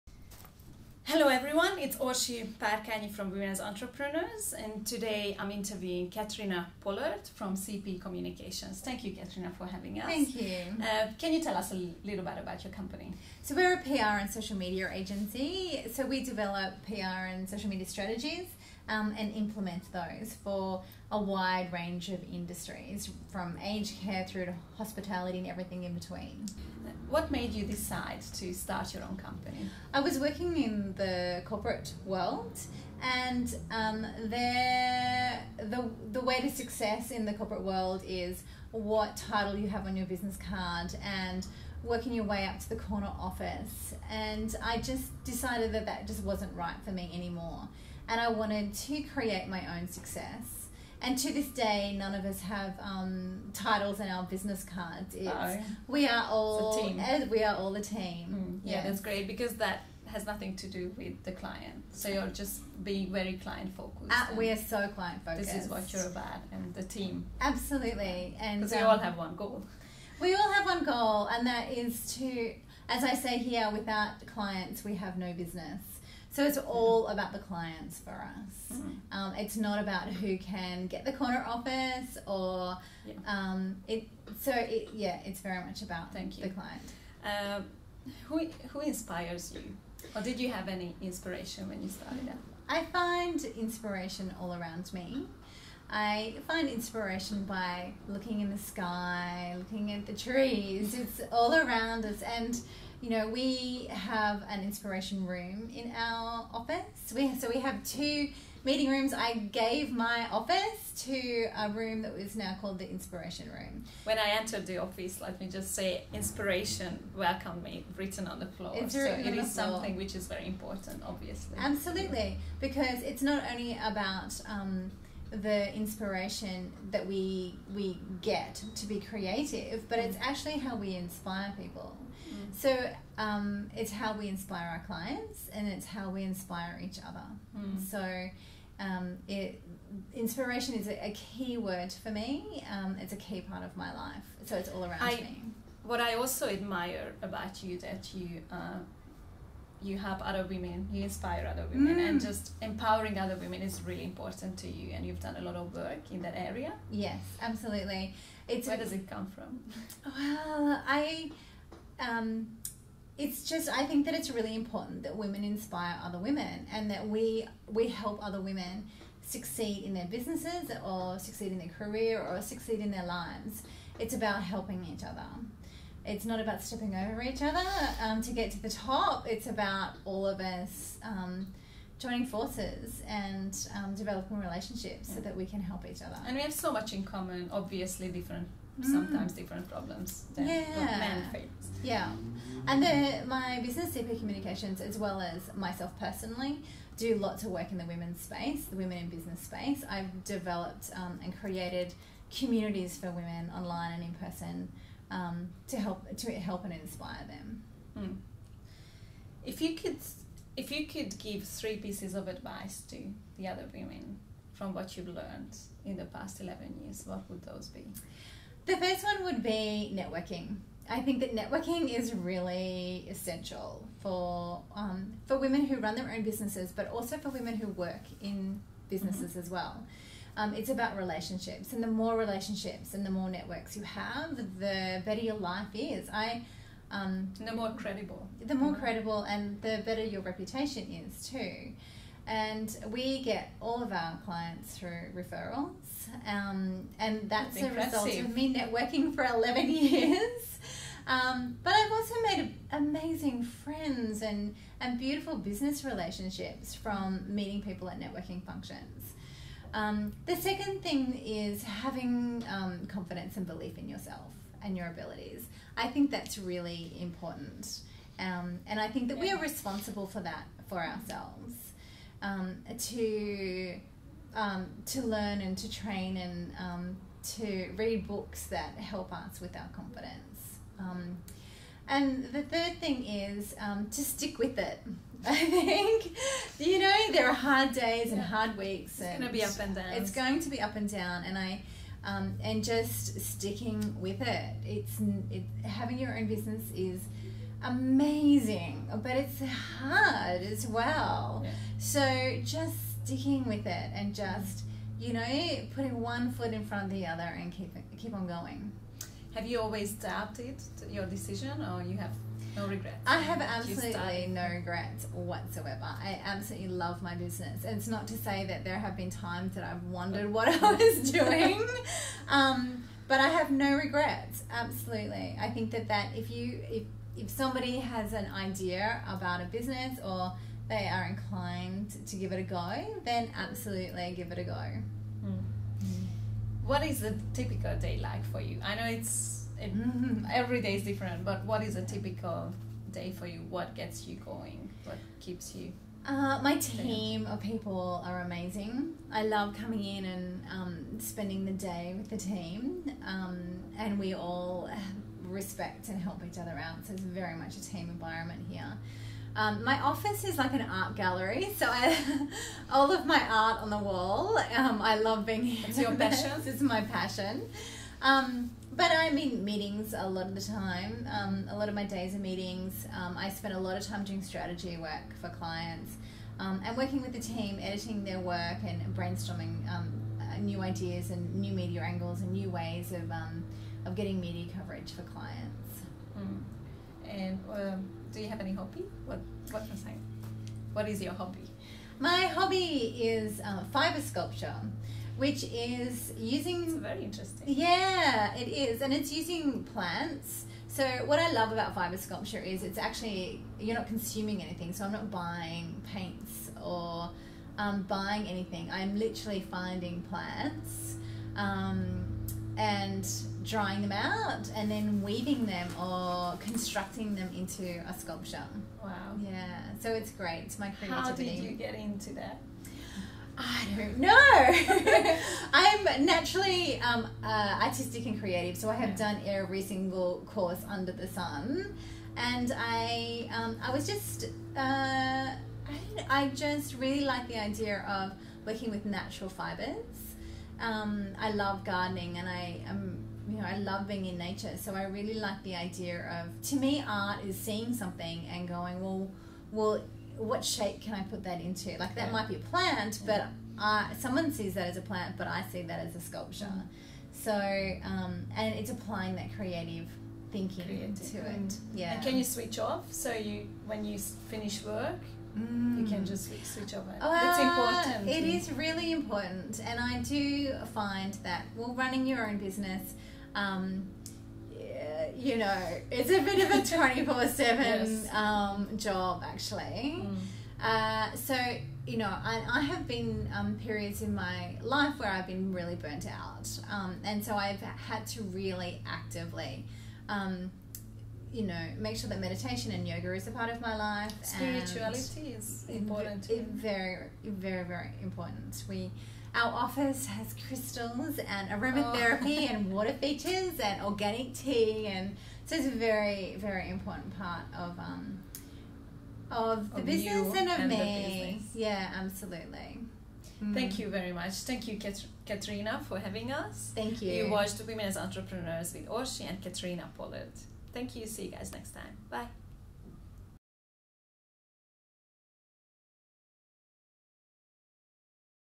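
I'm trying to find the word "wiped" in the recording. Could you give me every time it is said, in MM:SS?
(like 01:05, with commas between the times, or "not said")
not said.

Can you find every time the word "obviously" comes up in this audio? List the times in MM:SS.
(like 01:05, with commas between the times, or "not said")
02:01, 03:07.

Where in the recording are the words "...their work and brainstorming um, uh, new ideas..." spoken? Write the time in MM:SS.
06:18.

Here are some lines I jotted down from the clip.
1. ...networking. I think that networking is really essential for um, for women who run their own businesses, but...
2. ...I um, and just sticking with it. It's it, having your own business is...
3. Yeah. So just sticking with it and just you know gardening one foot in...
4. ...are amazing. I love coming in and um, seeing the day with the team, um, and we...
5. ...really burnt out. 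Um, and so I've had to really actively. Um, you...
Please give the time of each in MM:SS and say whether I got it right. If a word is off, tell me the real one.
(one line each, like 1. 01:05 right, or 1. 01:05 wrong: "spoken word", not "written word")
1. 03:39 right
2. 04:51 right
3. 05:01 wrong: "putting", not "gardening"
4. 05:48 wrong: "spending", not "seeing"
5. 08:05 right.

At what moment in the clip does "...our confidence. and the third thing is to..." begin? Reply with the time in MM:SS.
04:39.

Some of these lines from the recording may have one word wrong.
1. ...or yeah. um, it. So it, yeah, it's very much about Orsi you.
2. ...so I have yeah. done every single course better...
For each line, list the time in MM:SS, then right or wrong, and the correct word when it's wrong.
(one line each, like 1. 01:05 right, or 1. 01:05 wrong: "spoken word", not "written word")
1. 01:22 wrong: "Thank", not "Orsi"
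2. 07:08 wrong: "under", not "better".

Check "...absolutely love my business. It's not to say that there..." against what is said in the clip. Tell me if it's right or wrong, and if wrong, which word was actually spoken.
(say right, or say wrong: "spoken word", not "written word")
right.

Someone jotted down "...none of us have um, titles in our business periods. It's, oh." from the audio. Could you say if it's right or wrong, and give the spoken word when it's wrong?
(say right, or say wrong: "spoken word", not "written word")
wrong: "cards", not "periods".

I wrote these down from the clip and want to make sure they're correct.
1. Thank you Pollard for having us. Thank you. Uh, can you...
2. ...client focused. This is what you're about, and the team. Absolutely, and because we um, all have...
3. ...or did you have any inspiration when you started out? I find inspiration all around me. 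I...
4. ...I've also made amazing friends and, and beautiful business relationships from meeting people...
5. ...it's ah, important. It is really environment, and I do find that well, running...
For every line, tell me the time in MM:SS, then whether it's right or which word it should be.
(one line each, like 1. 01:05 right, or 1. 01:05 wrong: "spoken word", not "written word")
1. 00:08 wrong: "Catriona", not "Pollard"
2. 01:04 right
3. 01:30 right
4. 04:11 right
5. 07:46 wrong: "important", not "environment".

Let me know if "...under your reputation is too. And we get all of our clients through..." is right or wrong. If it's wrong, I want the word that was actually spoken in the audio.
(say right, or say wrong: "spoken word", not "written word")
wrong: "better", not "under".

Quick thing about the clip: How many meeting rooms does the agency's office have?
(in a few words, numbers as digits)
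2.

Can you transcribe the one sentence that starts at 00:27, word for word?
What made you decide to start your own company?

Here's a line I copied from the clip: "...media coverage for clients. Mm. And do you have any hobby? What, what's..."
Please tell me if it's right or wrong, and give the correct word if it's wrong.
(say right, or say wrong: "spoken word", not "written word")
right.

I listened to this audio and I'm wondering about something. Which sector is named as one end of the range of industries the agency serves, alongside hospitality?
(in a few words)
aged care.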